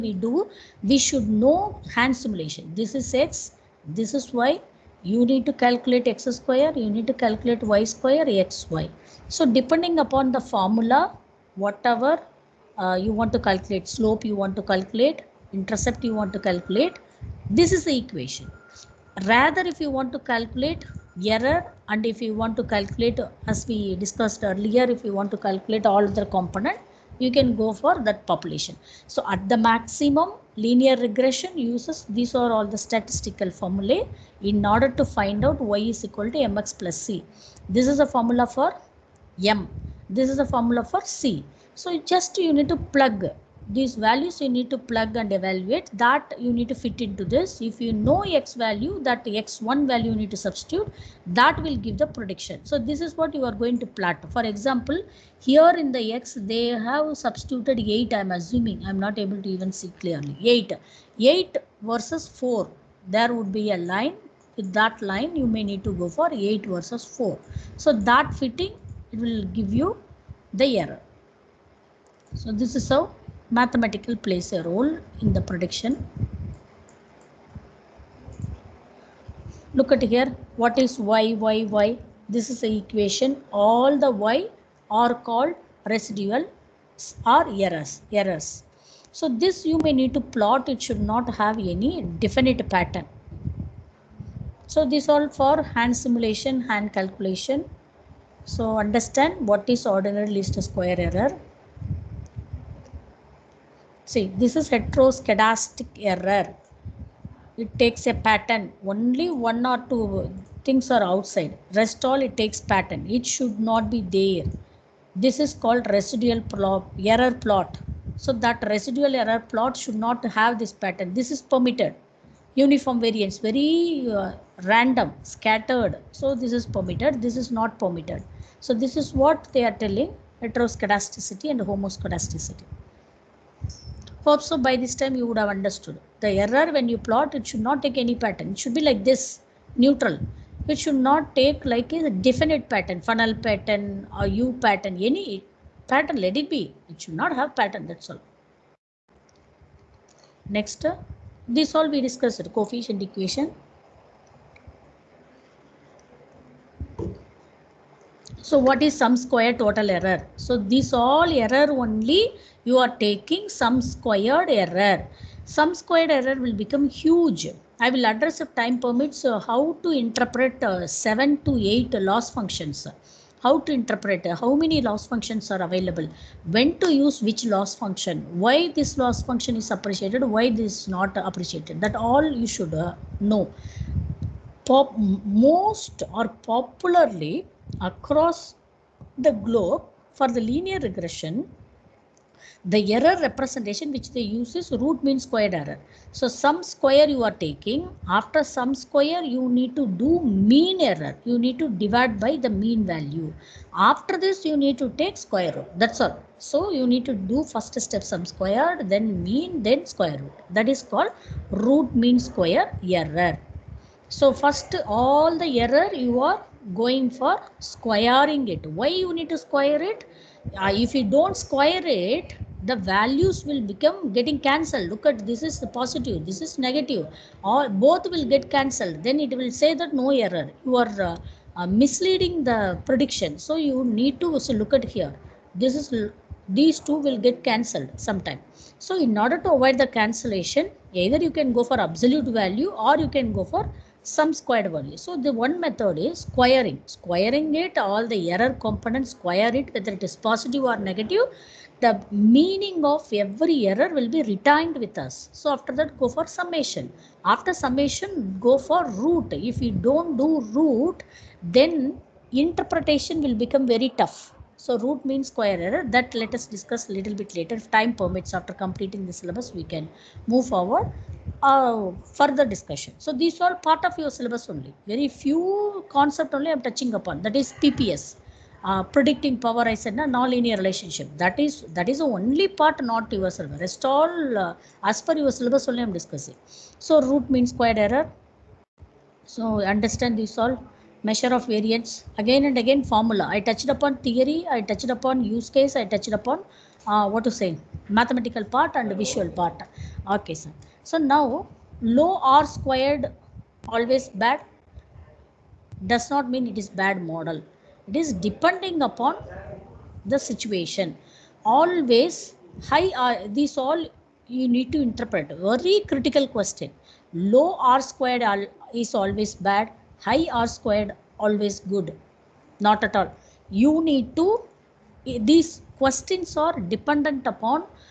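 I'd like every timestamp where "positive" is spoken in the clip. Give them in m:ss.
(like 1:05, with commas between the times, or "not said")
3:45, 4:10.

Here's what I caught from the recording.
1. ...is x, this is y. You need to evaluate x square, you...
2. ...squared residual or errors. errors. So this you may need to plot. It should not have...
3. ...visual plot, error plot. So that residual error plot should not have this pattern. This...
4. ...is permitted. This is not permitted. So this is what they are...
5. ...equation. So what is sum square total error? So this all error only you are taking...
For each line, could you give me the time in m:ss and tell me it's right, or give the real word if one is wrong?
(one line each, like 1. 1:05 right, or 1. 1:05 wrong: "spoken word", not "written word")
1. 0:02 wrong: "calculate", not "evaluate"
2. 1:25 wrong: "called", not "squared"
3. 1:55 wrong: "residual", not "visual"
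4. 2:06 right
5. 2:33 right.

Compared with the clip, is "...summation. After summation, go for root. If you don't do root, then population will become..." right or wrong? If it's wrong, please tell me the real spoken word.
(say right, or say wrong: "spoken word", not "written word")
wrong: "interpretation", not "population".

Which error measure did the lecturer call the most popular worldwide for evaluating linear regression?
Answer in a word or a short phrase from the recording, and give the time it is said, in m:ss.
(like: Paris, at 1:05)
root mean squared error, at 3:14.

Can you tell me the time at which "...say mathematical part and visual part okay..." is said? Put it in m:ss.
4:57.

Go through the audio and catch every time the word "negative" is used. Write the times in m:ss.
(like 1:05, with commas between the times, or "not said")
3:46, 4:10.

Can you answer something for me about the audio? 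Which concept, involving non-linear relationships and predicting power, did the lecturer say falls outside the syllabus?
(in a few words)
PPS.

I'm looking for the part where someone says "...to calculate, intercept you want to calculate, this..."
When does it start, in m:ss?
0:14.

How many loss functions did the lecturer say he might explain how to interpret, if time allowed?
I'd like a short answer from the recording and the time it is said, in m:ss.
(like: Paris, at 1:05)
7 to 8, at 2:50.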